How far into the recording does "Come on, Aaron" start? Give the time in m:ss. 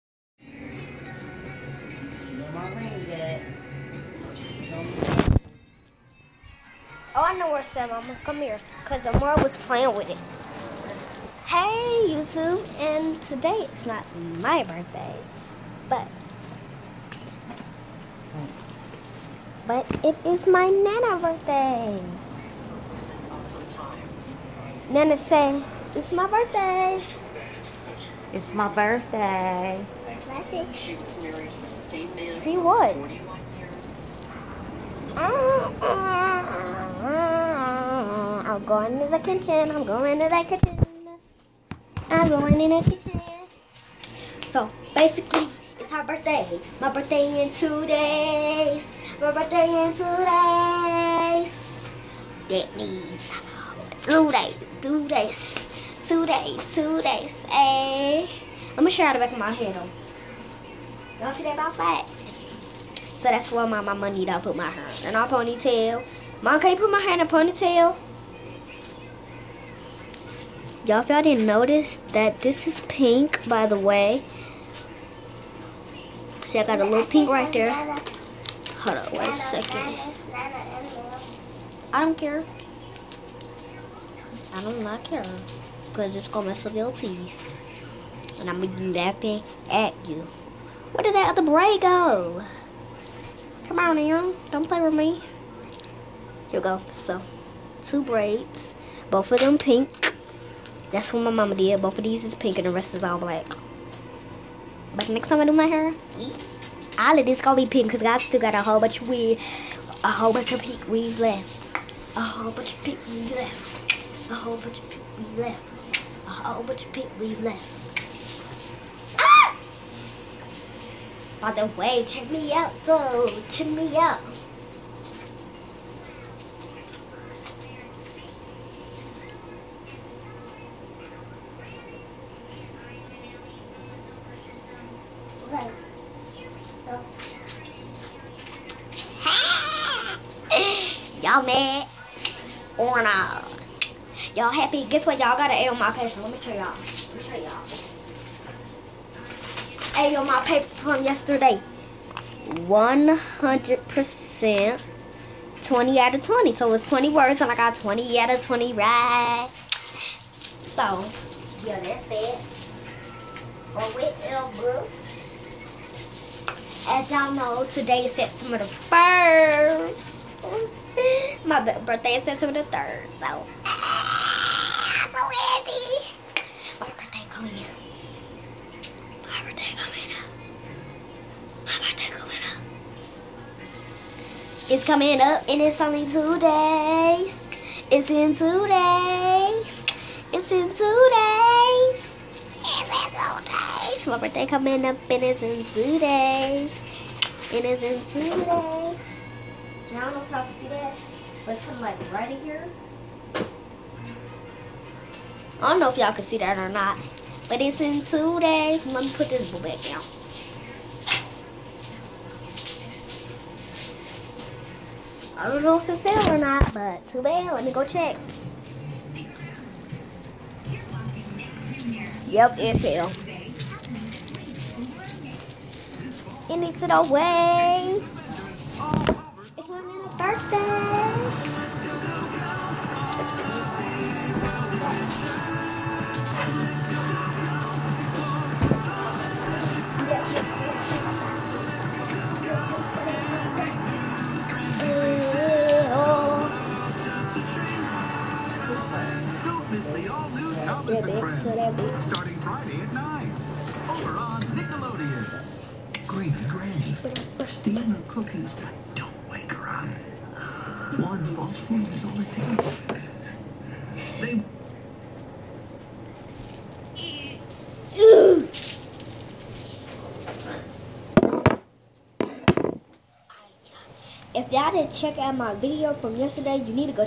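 1:33.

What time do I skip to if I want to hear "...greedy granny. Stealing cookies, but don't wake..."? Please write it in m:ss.
4:16.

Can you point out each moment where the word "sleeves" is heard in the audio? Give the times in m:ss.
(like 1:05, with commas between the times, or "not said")
not said.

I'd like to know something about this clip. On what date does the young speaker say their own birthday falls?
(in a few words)
September 3rd.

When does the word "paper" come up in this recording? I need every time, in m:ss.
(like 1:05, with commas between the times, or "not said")
2:25, 2:30.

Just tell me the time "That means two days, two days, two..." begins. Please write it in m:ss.
0:52.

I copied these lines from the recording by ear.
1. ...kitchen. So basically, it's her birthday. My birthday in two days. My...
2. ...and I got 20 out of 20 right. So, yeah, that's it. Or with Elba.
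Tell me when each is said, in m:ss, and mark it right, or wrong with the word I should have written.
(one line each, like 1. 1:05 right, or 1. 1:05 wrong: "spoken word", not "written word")
1. 0:42 right
2. 2:37 right.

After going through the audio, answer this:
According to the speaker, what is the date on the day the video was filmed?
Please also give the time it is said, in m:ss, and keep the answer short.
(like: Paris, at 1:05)
September 1st, at 2:48.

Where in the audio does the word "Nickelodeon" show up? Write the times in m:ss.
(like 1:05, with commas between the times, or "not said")
4:14.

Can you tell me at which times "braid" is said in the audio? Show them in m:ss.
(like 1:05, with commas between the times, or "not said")
1:31, 1:38.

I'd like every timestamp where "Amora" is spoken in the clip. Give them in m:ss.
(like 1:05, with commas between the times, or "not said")
0:09.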